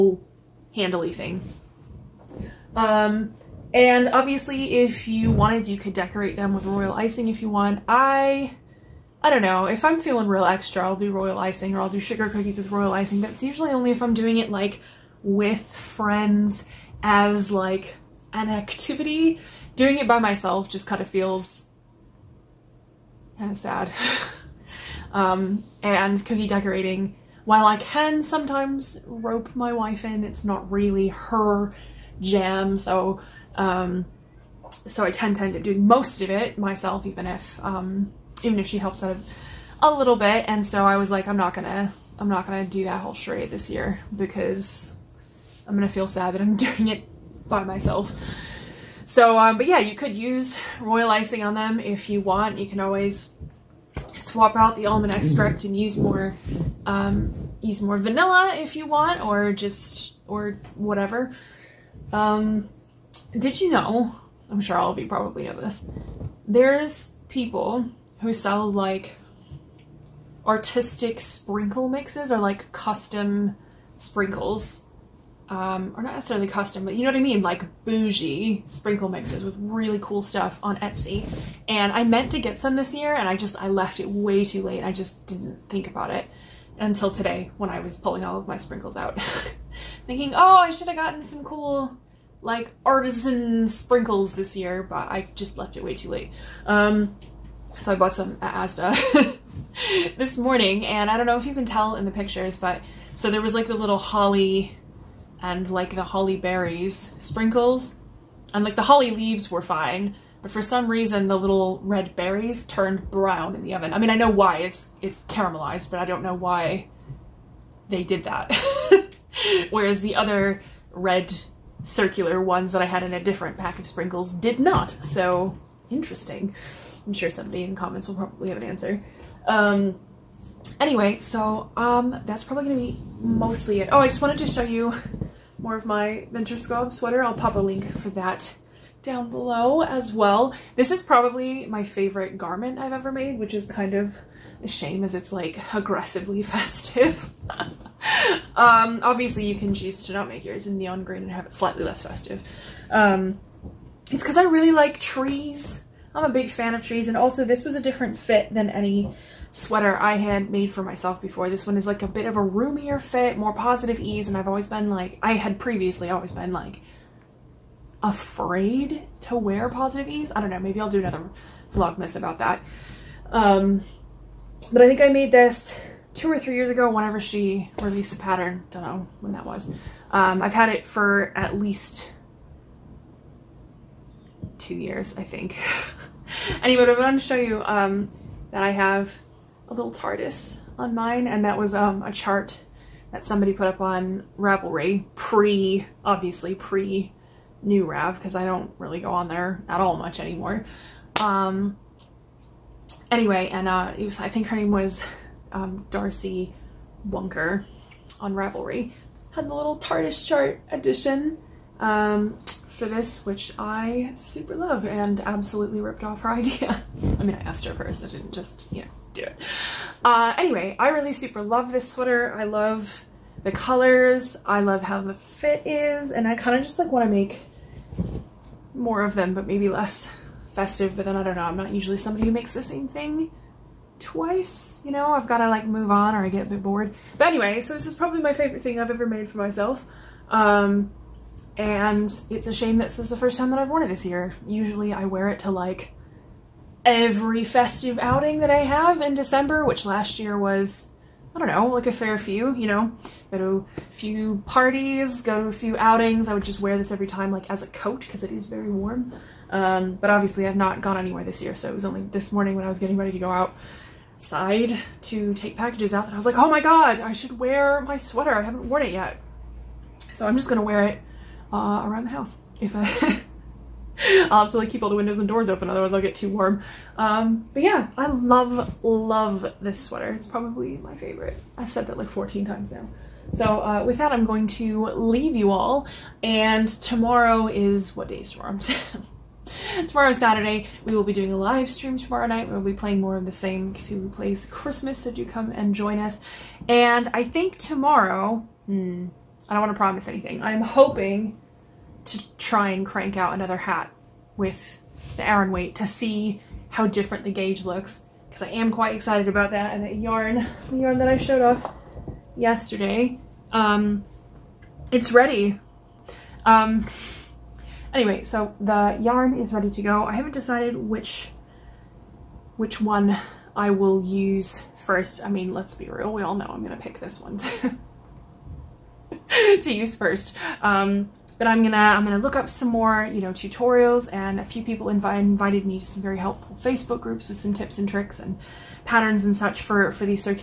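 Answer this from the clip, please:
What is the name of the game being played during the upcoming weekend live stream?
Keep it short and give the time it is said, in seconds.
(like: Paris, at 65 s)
Cthulhu Plays Christmas, at 293 s.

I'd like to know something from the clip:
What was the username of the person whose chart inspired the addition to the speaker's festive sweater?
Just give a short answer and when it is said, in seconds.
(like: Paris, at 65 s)
Darcy Wonker, at 205 s.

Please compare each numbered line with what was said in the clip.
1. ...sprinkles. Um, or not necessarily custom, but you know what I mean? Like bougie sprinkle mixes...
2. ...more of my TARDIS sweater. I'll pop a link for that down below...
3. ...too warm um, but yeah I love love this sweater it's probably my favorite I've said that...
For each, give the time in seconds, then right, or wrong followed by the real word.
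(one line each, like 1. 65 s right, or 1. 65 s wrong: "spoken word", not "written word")
1. 73 s right
2. 135 s wrong: "Winter", not "TARDIS"
3. 276 s right.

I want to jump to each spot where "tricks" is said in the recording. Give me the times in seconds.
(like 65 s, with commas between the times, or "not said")
337 s.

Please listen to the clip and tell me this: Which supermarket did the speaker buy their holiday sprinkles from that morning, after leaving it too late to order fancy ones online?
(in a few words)
Asda.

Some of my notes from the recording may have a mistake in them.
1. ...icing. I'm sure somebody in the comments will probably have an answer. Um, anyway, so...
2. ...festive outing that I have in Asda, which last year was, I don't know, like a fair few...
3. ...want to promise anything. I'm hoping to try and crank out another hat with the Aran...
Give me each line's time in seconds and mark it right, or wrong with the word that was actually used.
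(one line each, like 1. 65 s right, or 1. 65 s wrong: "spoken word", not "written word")
1. 125 s wrong: "interesting", not "icing"
2. 247 s wrong: "December", not "Asda"
3. 299 s right.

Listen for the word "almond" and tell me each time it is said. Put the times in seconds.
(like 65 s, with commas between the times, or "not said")
54 s.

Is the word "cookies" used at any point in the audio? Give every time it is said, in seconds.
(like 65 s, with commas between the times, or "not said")
12 s, 26 s.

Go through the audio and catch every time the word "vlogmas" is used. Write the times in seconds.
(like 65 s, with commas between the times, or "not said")
171 s.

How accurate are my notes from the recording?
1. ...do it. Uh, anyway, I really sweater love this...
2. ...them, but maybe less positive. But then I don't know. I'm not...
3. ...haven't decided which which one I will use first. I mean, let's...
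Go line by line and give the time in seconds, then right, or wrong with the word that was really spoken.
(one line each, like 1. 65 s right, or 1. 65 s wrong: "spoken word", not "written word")
1. 219 s wrong: "super", not "sweater"
2. 229 s wrong: "festive", not "positive"
3. 320 s right.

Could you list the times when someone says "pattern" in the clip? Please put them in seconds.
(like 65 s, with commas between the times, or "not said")
178 s, 338 s.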